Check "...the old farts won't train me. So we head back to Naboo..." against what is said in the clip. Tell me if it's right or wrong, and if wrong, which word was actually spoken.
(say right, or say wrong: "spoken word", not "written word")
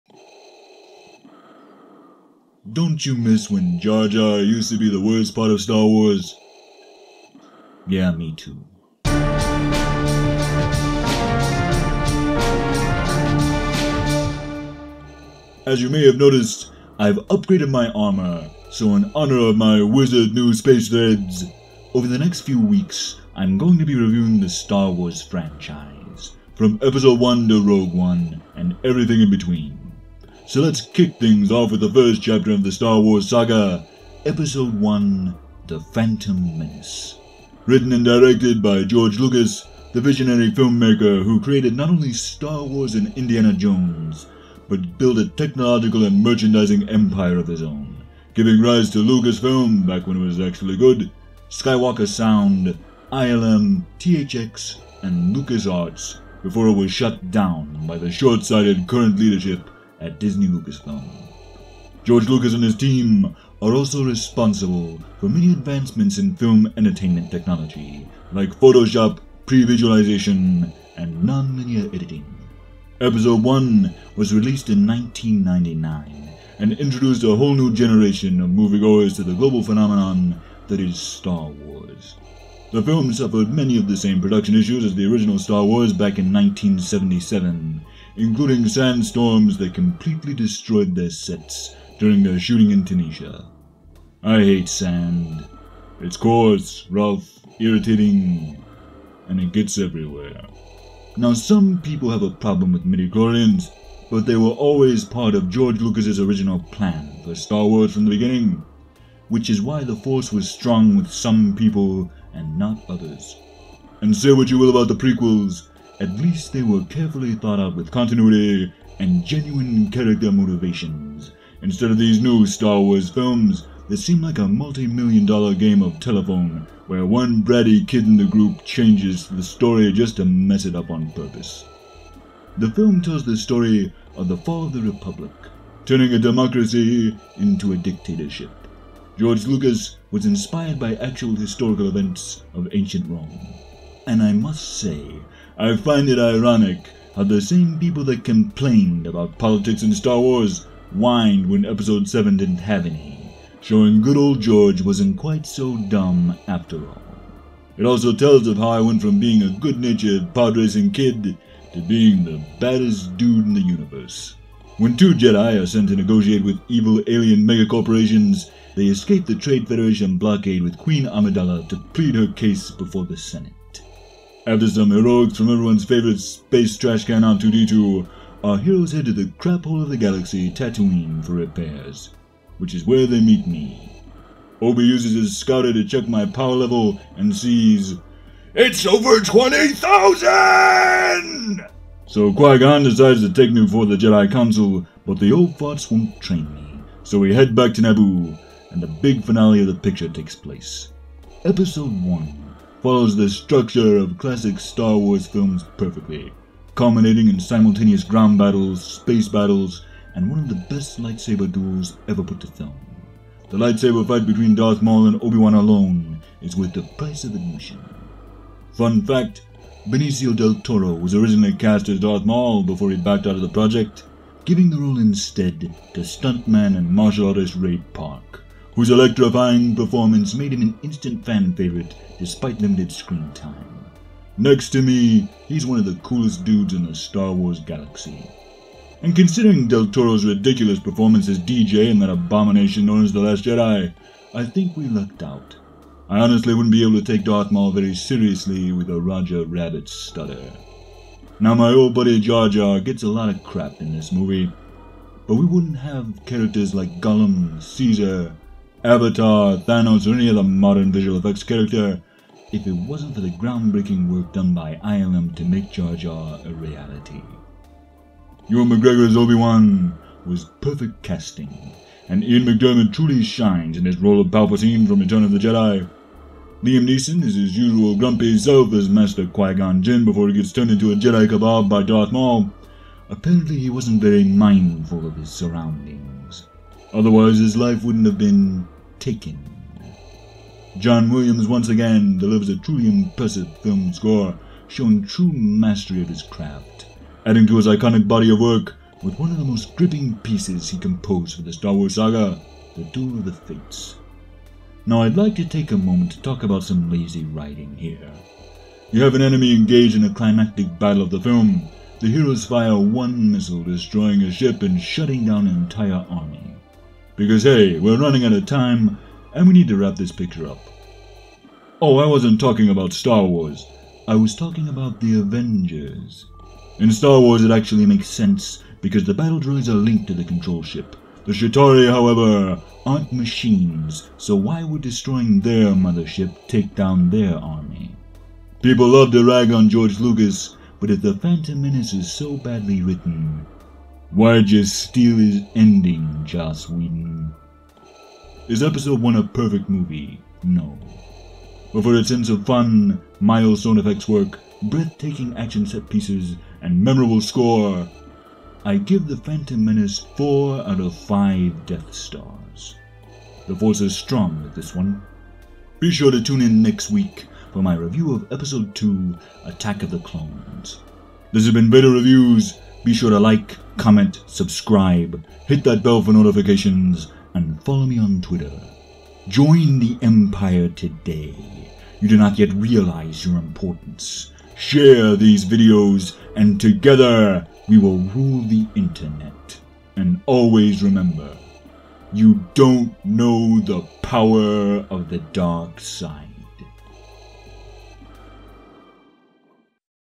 right.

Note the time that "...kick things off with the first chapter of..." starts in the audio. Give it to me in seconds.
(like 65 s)
30 s.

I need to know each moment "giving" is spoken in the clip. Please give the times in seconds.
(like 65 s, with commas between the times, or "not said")
48 s, 224 s.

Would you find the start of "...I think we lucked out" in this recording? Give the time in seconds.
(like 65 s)
244 s.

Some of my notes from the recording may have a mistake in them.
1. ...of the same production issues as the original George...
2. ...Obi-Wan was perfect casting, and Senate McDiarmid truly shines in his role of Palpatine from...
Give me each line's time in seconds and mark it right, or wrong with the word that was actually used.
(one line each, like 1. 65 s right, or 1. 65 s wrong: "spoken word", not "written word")
1. 83 s wrong: "Star", not "George"
2. 269 s wrong: "Ian", not "Senate".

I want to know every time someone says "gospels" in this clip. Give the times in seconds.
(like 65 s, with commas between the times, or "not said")
not said.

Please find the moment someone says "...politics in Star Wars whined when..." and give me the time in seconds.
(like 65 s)
149 s.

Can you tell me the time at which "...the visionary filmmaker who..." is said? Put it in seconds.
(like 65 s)
39 s.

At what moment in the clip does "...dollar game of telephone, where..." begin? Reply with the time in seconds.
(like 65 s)
125 s.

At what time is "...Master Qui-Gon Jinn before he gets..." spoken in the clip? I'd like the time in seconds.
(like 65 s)
278 s.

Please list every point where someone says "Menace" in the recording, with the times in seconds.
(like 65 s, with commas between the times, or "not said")
36 s, 341 s, 359 s.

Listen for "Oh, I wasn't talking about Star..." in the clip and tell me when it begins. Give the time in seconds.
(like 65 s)
321 s.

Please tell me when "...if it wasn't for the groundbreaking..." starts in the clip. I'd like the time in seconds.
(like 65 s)
262 s.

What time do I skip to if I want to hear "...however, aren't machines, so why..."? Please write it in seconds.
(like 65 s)
331 s.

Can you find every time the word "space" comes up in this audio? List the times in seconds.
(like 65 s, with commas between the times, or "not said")
20 s, 176 s, 208 s.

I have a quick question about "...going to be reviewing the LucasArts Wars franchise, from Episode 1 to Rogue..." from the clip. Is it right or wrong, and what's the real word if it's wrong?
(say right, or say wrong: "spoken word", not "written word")
wrong: "Star", not "LucasArts".